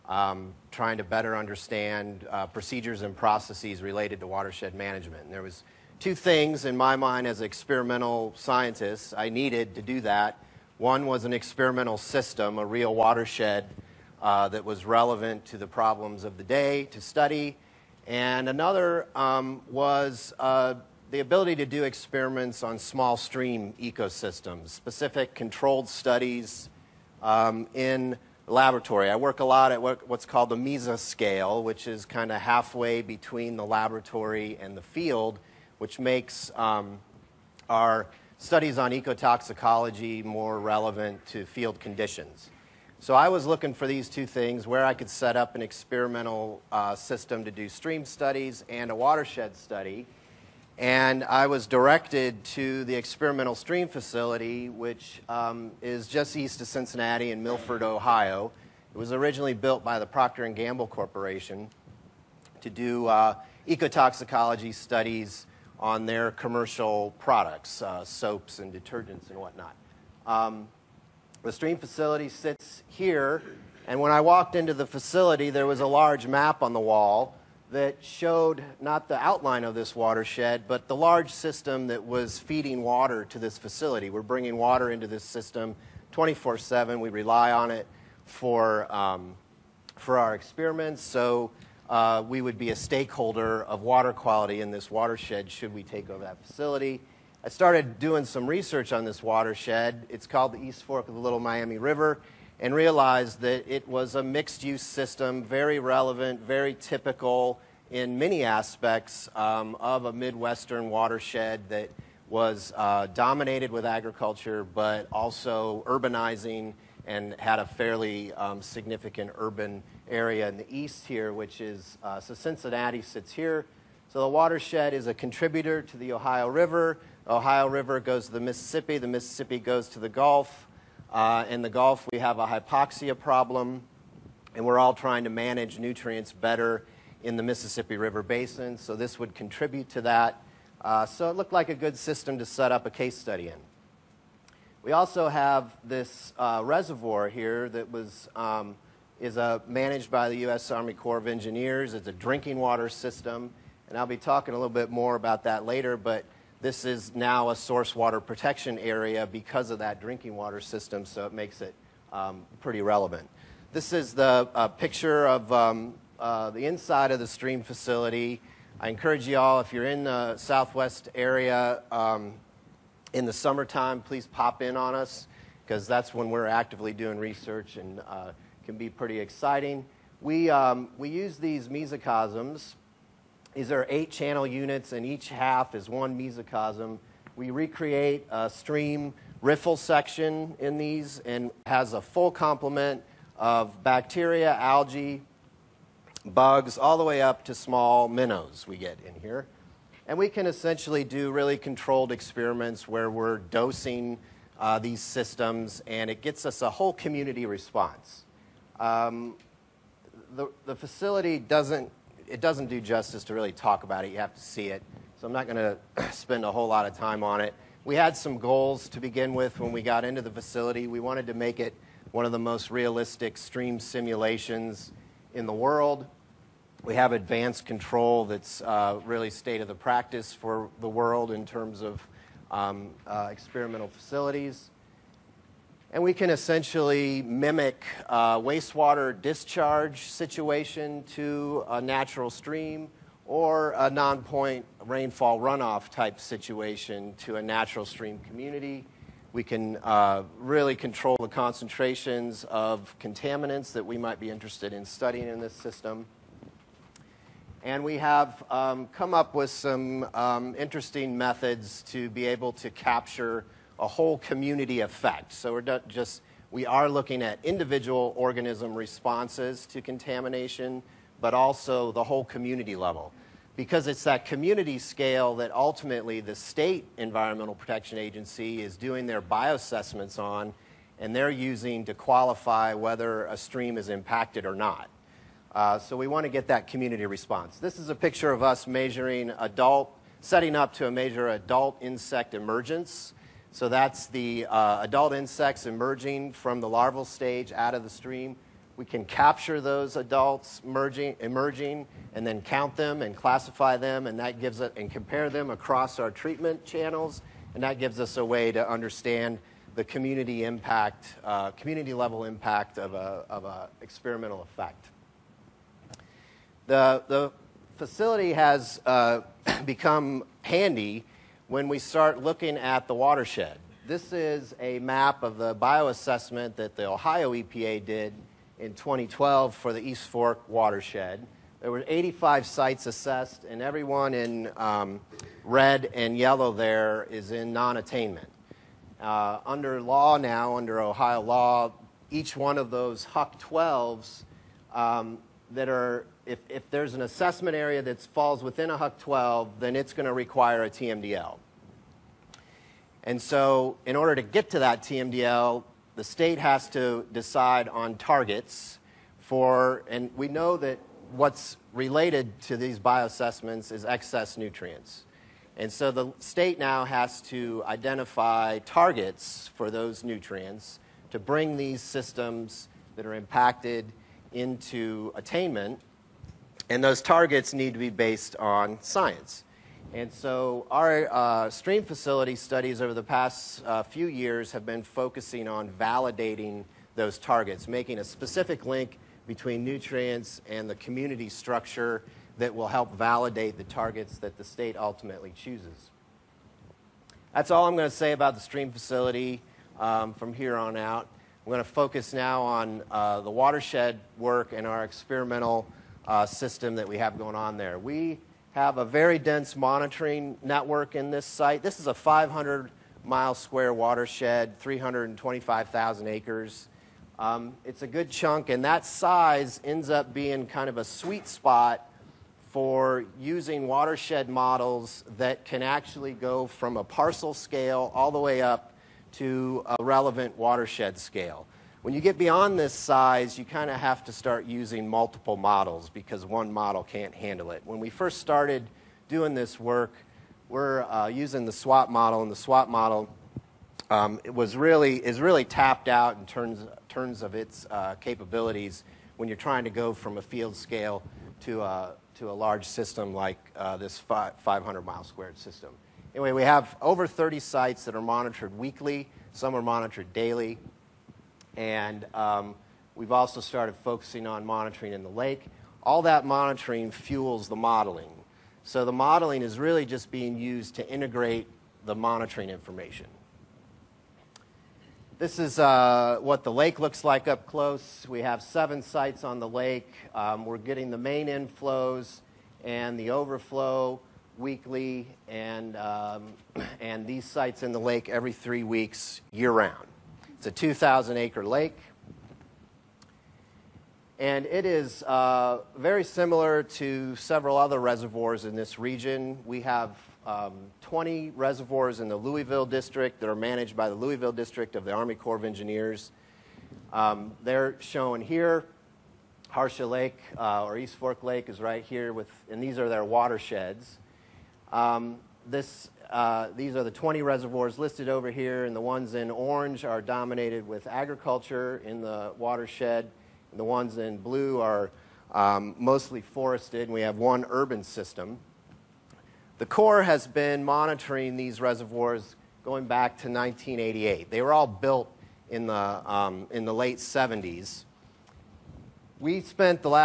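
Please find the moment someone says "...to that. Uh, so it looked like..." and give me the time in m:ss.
2:19.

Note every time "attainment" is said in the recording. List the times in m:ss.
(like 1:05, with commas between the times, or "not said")
5:37, 6:15.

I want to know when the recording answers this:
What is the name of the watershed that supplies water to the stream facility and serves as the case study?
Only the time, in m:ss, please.
1:40.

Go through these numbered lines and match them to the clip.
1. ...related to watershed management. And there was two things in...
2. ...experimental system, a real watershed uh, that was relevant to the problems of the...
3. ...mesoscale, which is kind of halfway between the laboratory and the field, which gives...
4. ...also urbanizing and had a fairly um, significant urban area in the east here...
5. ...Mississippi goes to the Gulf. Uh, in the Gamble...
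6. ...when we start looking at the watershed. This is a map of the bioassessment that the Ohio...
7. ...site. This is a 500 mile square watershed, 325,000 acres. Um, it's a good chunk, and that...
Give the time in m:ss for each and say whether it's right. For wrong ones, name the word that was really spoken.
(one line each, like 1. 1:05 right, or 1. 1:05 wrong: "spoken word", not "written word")
1. 0:03 right
2. 0:11 right
3. 0:30 wrong: "makes", not "gives"
4. 1:55 right
5. 2:09 wrong: "Gulf", not "Gamble"
6. 5:21 right
7. 6:51 right.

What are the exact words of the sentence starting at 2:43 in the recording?
This is the uh, picture of um, uh, the inside of the stream facility.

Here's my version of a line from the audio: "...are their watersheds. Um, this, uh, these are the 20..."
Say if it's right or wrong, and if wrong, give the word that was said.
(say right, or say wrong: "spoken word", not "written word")
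right.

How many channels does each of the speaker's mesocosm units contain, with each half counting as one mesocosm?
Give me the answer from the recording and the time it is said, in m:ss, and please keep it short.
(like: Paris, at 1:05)
8, at 3:03.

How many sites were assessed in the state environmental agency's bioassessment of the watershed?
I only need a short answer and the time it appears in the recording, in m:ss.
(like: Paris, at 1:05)
85, at 5:31.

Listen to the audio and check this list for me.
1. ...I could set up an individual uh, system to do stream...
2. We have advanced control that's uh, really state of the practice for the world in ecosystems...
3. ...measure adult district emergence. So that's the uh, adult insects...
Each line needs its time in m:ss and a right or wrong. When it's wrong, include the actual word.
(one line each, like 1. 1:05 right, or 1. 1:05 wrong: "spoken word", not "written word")
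1. 0:44 wrong: "experimental", not "individual"
2. 3:46 wrong: "terms", not "ecosystems"
3. 4:50 wrong: "insect", not "district".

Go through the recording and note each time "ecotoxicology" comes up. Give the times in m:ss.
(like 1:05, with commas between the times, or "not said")
0:38, 1:03.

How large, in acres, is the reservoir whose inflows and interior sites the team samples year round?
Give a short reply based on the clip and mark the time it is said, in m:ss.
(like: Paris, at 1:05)
2,000 acres, at 8:10.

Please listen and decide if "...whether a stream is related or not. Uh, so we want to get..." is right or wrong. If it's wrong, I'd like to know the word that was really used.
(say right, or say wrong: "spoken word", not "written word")
wrong: "impacted", not "related".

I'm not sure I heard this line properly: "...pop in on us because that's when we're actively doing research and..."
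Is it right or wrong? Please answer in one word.
right.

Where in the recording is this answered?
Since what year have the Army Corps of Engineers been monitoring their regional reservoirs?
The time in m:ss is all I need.
8:53.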